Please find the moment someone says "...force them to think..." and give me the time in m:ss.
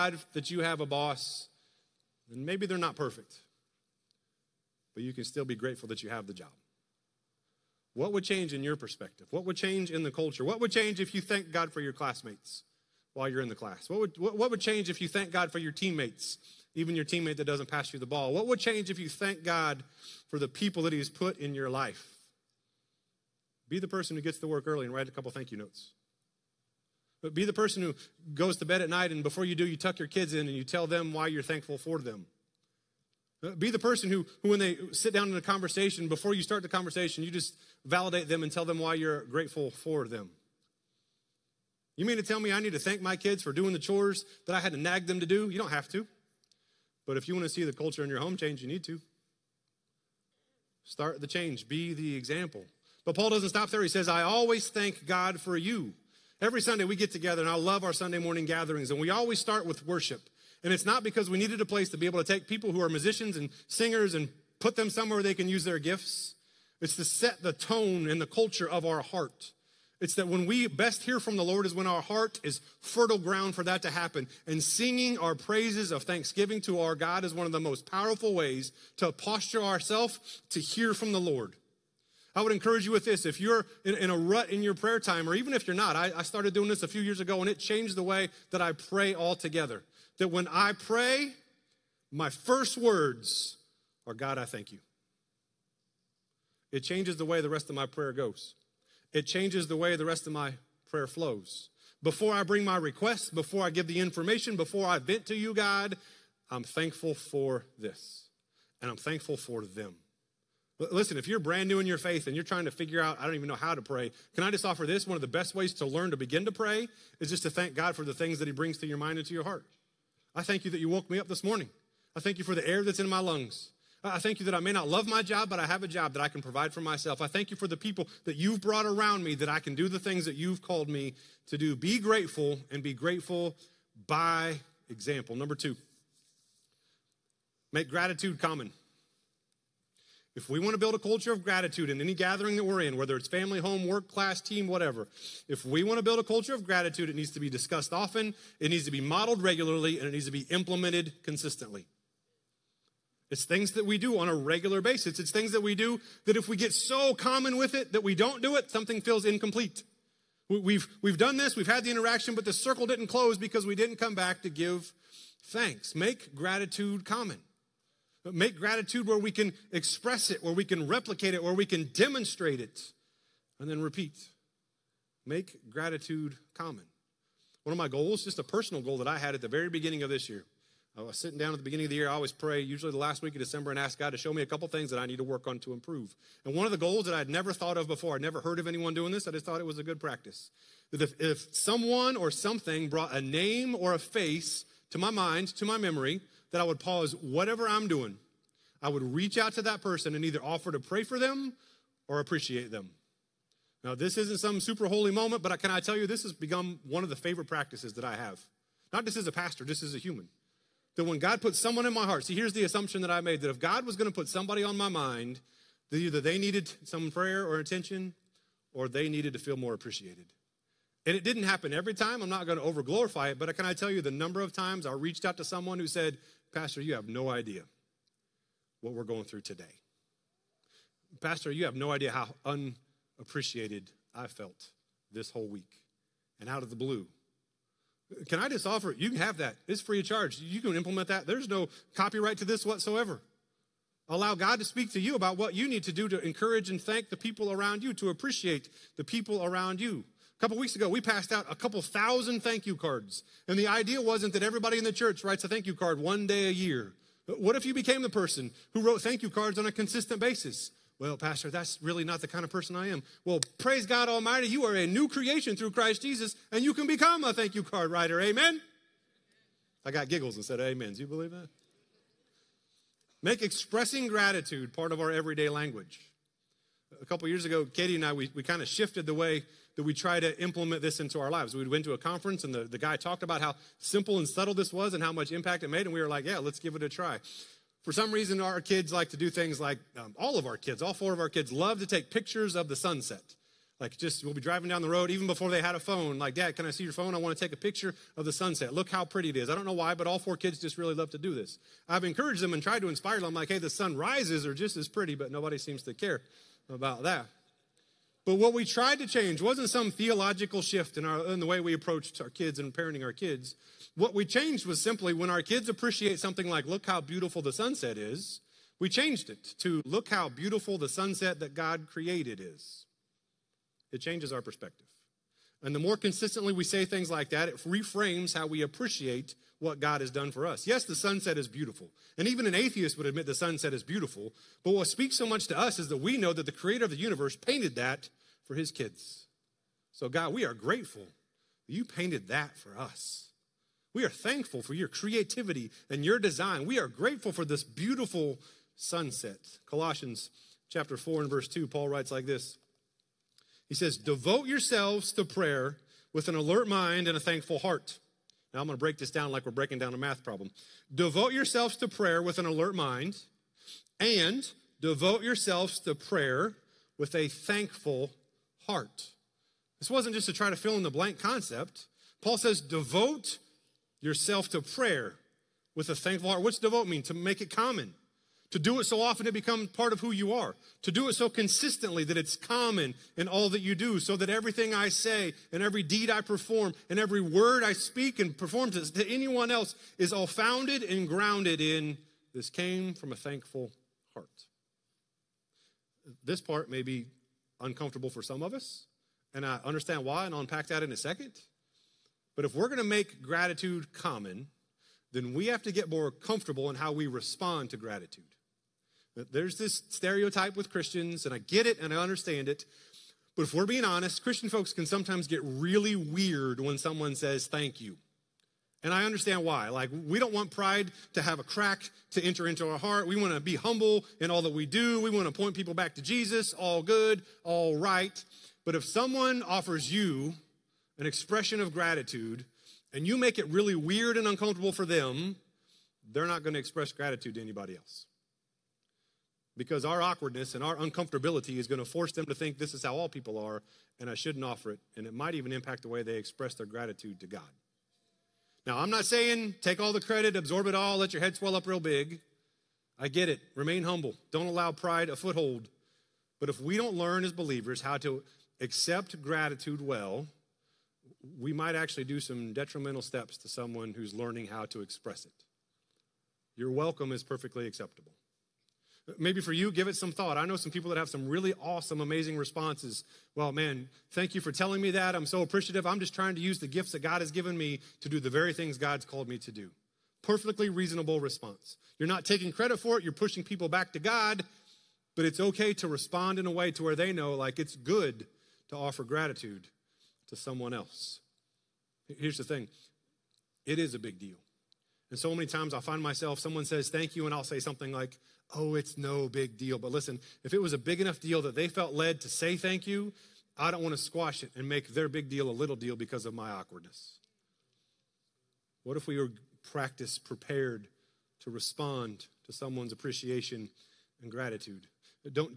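7:21.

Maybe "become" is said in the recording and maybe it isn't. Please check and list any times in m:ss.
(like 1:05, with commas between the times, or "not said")
3:26, 4:26, 6:19.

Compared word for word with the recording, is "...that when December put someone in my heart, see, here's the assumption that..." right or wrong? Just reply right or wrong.
wrong.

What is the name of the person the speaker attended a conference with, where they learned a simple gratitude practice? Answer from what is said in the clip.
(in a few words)
Katie.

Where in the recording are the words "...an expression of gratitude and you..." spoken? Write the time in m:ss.
7:11.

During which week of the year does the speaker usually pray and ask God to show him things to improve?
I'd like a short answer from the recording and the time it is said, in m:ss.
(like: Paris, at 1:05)
Last week of December, at 3:02.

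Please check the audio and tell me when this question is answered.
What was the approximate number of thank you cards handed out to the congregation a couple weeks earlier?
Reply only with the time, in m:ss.
4:11.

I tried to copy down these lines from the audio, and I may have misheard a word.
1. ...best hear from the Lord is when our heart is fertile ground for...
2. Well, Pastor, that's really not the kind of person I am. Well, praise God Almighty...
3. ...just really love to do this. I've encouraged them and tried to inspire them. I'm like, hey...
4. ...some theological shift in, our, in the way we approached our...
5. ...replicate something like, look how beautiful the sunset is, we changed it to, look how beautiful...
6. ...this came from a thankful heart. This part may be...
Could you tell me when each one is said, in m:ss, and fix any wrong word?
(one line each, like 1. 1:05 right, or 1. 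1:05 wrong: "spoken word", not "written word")
1. 1:10 right
2. 4:20 right
3. 5:00 right
4. 5:09 right
5. 5:15 wrong: "appreciate", not "replicate"
6. 6:32 right.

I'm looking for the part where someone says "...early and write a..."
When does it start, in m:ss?
0:24.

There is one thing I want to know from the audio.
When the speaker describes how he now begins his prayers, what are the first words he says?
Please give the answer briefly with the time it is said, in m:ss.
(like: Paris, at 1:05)
God, I thank you, at 1:34.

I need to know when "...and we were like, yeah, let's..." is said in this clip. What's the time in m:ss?
4:45.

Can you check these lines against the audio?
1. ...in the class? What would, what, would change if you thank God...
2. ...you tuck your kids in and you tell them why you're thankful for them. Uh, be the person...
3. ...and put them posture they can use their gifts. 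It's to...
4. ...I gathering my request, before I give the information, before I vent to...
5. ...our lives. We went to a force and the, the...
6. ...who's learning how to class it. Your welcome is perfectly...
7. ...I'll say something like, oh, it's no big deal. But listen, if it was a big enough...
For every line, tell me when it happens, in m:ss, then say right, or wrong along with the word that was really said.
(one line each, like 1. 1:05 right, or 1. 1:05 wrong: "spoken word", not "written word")
1. 0:13 right
2. 0:29 right
3. 1:04 wrong: "somewhere", not "posture"
4. 1:42 wrong: "bring", not "gathering"
5. 4:41 wrong: "conference", not "force"
6. 7:43 wrong: "express", not "class"
7. 8:17 right.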